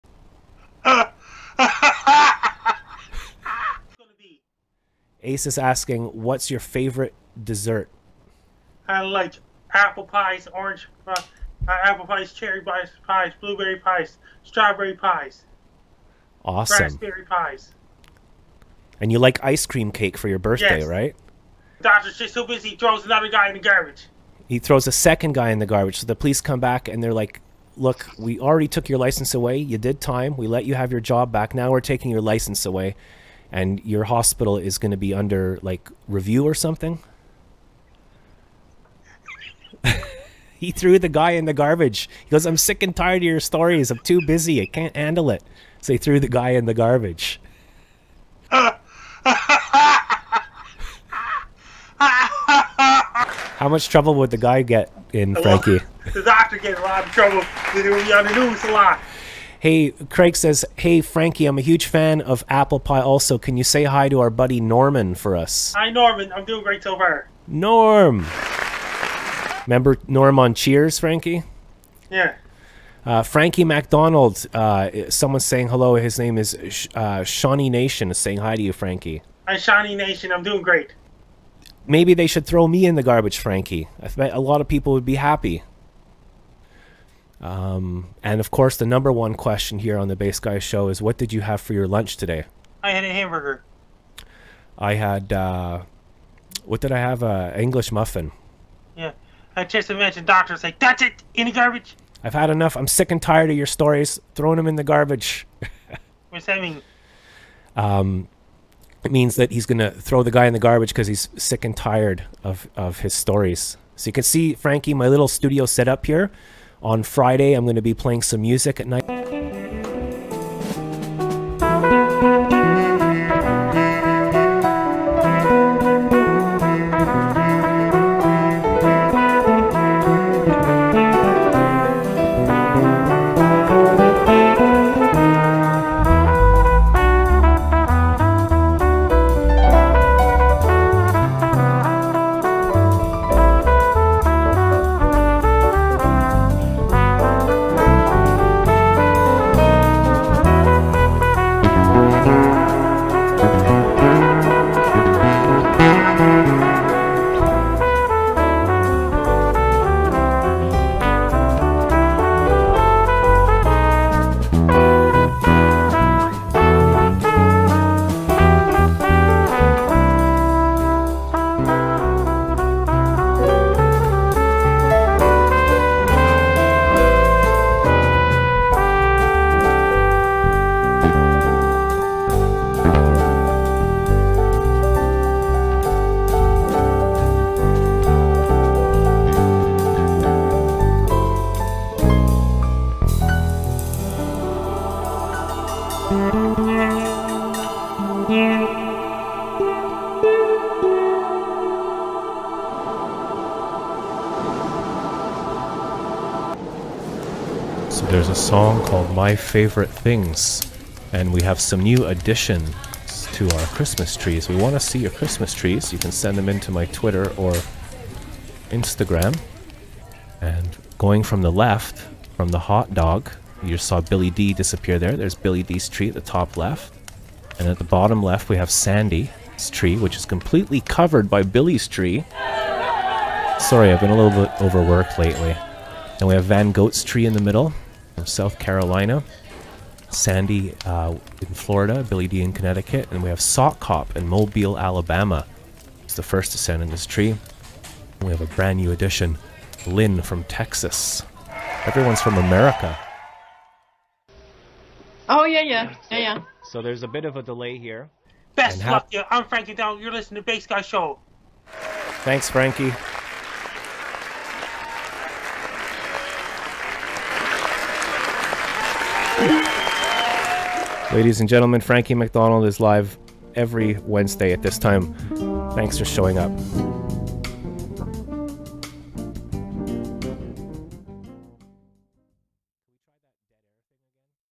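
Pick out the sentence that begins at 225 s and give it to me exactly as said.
There's Billy D's tree at the top left.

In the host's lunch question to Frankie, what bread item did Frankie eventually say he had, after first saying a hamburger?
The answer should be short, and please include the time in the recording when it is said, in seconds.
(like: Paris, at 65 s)
English muffin, at 97 s.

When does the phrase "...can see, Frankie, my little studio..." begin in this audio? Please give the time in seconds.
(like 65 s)
114 s.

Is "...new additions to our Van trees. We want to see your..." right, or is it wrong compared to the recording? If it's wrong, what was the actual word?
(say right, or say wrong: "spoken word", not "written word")
wrong: "Christmas", not "Van".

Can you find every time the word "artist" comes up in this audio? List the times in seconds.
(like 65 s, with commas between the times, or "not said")
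not said.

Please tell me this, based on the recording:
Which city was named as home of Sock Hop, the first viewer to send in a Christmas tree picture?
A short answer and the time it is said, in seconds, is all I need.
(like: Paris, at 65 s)
Mobile, Alabama, at 244 s.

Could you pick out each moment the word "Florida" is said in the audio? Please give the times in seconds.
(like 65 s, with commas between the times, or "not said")
241 s.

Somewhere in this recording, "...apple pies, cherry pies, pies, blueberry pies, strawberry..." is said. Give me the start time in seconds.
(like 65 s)
11 s.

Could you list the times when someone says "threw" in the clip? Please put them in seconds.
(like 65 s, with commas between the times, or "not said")
40 s, 45 s.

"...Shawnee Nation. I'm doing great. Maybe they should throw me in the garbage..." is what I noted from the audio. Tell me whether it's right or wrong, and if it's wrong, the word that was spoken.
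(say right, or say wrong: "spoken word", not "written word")
right.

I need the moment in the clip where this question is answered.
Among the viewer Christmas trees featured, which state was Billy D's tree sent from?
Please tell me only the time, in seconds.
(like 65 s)
242 s.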